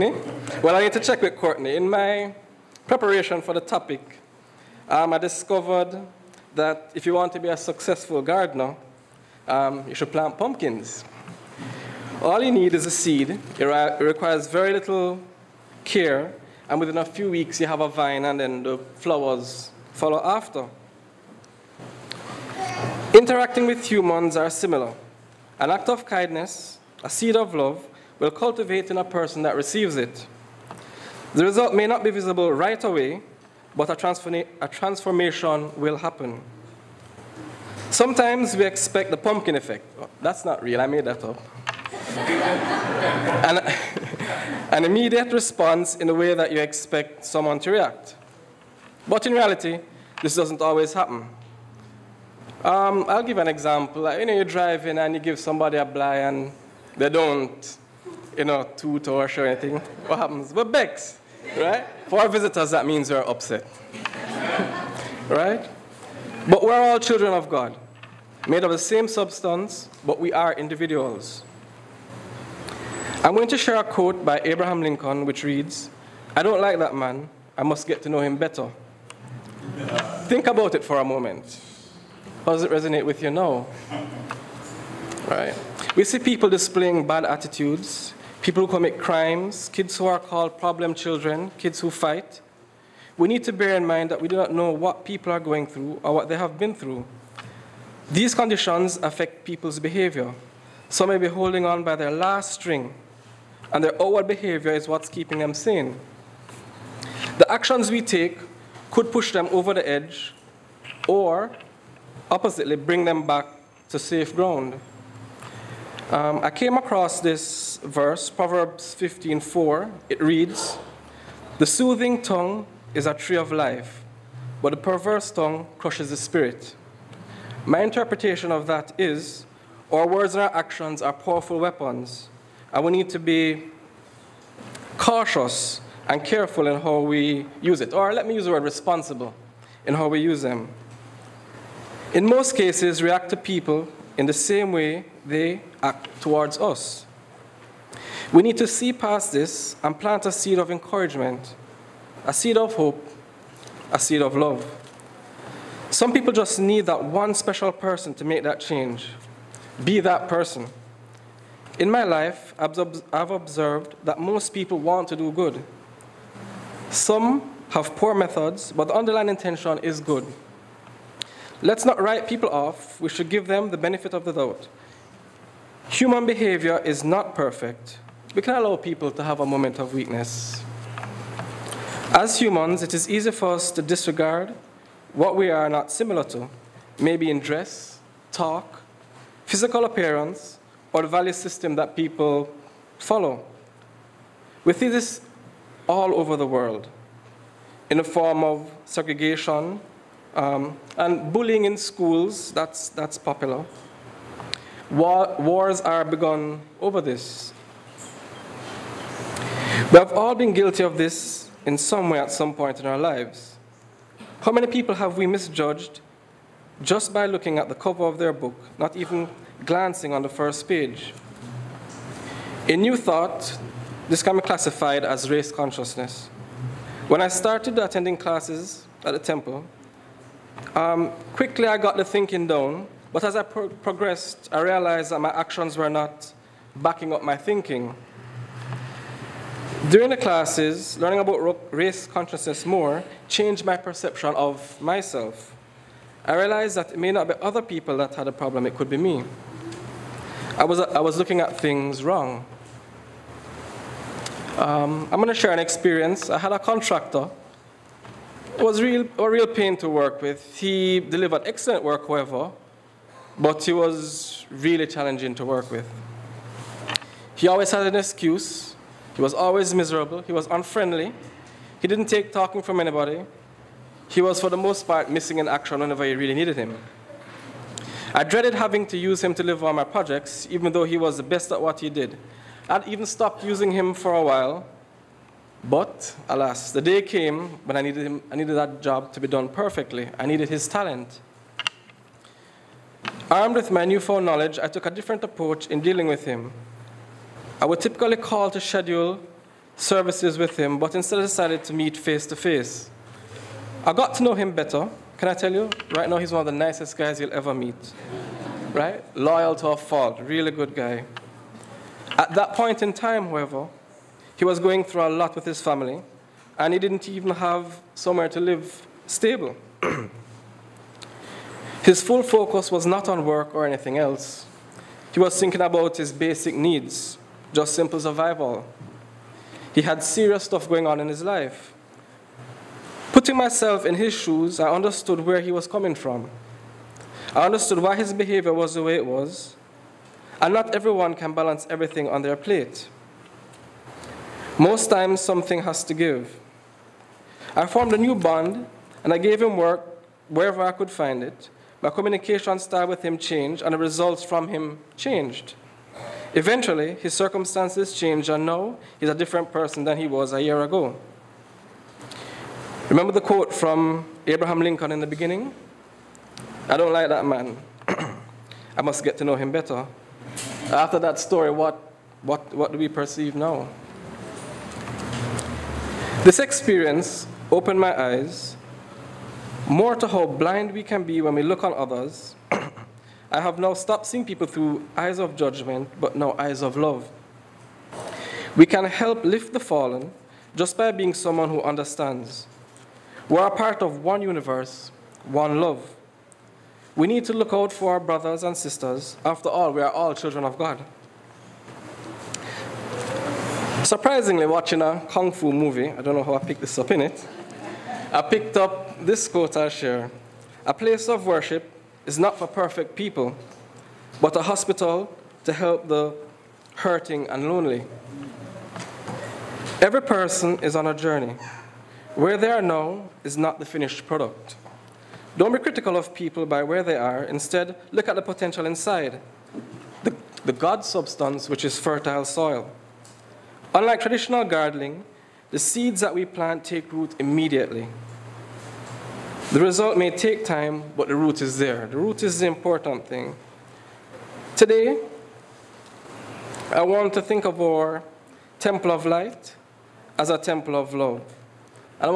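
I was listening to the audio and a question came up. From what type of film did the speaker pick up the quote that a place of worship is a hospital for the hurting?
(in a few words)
Kung fu movie.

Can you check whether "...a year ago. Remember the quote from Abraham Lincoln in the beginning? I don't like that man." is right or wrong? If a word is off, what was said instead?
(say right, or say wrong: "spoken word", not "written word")
right.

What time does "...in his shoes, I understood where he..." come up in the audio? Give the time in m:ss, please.
5:33.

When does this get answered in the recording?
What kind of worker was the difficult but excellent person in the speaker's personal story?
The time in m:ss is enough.
4:16.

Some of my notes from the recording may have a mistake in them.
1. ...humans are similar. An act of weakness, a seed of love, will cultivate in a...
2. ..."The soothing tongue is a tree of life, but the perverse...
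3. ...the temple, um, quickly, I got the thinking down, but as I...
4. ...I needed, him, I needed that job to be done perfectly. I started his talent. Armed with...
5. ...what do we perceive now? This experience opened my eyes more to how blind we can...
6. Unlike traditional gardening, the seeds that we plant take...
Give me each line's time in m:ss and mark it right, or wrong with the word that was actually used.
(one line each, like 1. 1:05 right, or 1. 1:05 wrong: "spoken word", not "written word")
1. 0:23 wrong: "kindness", not "weakness"
2. 2:01 right
3. 3:49 right
4. 4:47 wrong: "needed", not "started"
5. 6:12 right
6. 7:13 right.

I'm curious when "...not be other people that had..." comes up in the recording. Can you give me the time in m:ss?
4:07.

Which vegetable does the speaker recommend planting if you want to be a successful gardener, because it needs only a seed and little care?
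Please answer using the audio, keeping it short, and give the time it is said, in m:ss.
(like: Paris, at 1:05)
Pumpkins, at 0:10.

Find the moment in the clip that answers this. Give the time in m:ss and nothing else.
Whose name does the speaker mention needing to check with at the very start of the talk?
0:01.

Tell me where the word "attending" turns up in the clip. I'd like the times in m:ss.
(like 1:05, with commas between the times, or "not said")
3:47.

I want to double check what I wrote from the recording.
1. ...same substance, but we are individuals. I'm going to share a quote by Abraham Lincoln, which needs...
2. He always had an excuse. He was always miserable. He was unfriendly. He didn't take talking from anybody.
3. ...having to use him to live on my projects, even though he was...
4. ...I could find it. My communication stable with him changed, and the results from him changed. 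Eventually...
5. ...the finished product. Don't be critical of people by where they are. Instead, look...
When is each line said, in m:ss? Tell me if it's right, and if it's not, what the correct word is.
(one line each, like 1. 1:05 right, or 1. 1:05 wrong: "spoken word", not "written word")
1. 1:08 wrong: "reads", not "needs"
2. 4:27 right
3. 4:38 right
4. 5:50 wrong: "style", not "stable"
5. 7:03 right.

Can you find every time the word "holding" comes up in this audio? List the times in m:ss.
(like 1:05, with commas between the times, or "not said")
1:41.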